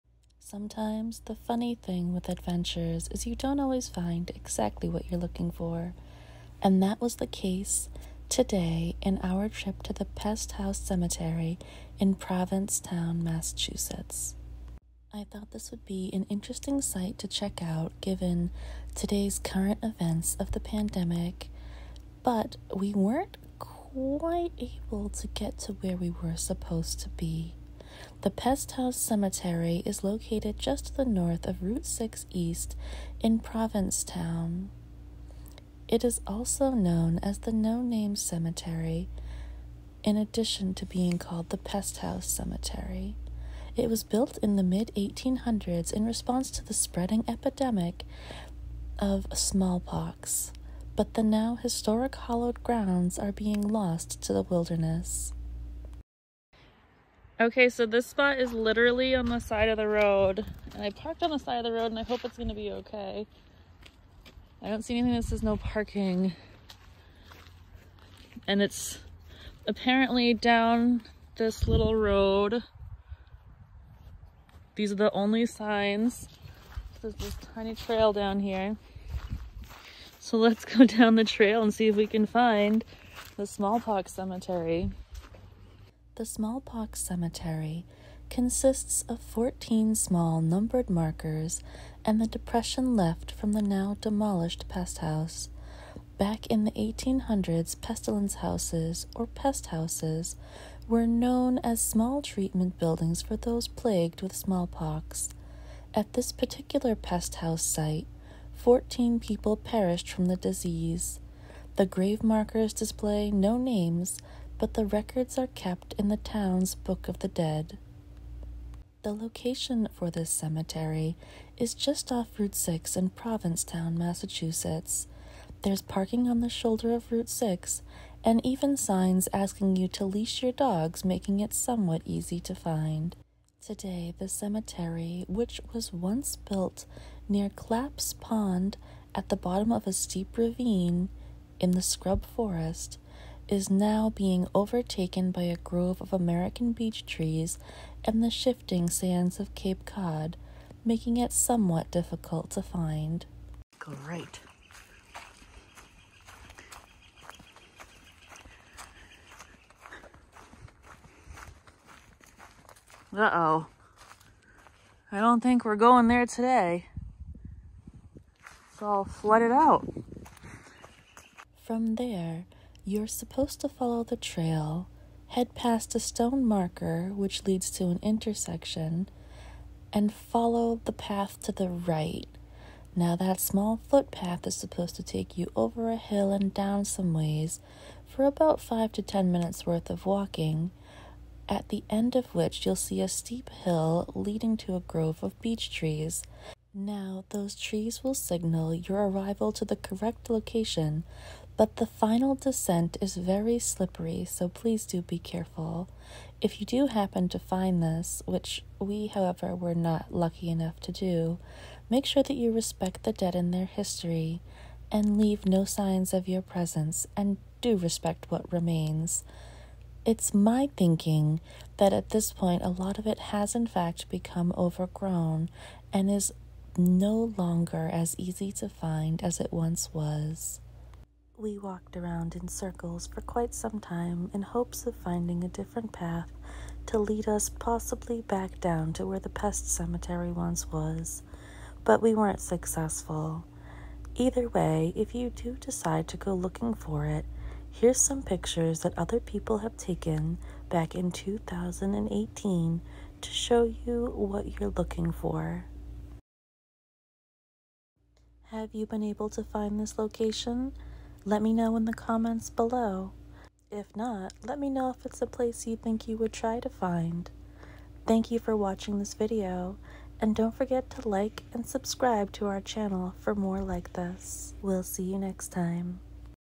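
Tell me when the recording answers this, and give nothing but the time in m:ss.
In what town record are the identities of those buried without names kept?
1:56.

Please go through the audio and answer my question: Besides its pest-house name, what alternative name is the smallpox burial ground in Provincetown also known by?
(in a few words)
No Name Cemetery.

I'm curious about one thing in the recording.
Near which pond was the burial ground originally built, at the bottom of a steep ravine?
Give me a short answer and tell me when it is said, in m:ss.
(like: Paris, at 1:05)
Clapp's Pond, at 2:17.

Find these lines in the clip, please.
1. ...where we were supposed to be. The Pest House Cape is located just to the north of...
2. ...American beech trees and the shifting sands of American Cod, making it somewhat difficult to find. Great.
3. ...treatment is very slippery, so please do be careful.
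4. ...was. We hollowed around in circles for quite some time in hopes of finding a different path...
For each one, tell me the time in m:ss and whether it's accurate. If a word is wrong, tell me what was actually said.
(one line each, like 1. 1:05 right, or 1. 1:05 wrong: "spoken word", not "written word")
1. 0:25 wrong: "Cemetery", not "Cape"
2. 2:26 wrong: "Cape", not "American"
3. 3:22 wrong: "descent", not "treatment"
4. 3:49 wrong: "walked", not "hollowed".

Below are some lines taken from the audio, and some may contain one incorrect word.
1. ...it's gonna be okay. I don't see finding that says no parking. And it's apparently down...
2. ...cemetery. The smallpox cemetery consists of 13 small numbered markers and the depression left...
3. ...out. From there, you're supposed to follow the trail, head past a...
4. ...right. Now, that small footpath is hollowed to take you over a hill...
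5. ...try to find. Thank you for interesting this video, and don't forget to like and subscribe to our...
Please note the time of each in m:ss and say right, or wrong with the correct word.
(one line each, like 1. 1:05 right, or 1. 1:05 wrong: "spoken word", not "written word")
1. 1:02 wrong: "anything", not "finding"
2. 1:24 wrong: "14", not "13"
3. 2:49 right
4. 3:01 wrong: "supposed", not "hollowed"
5. 4:26 wrong: "watching", not "interesting".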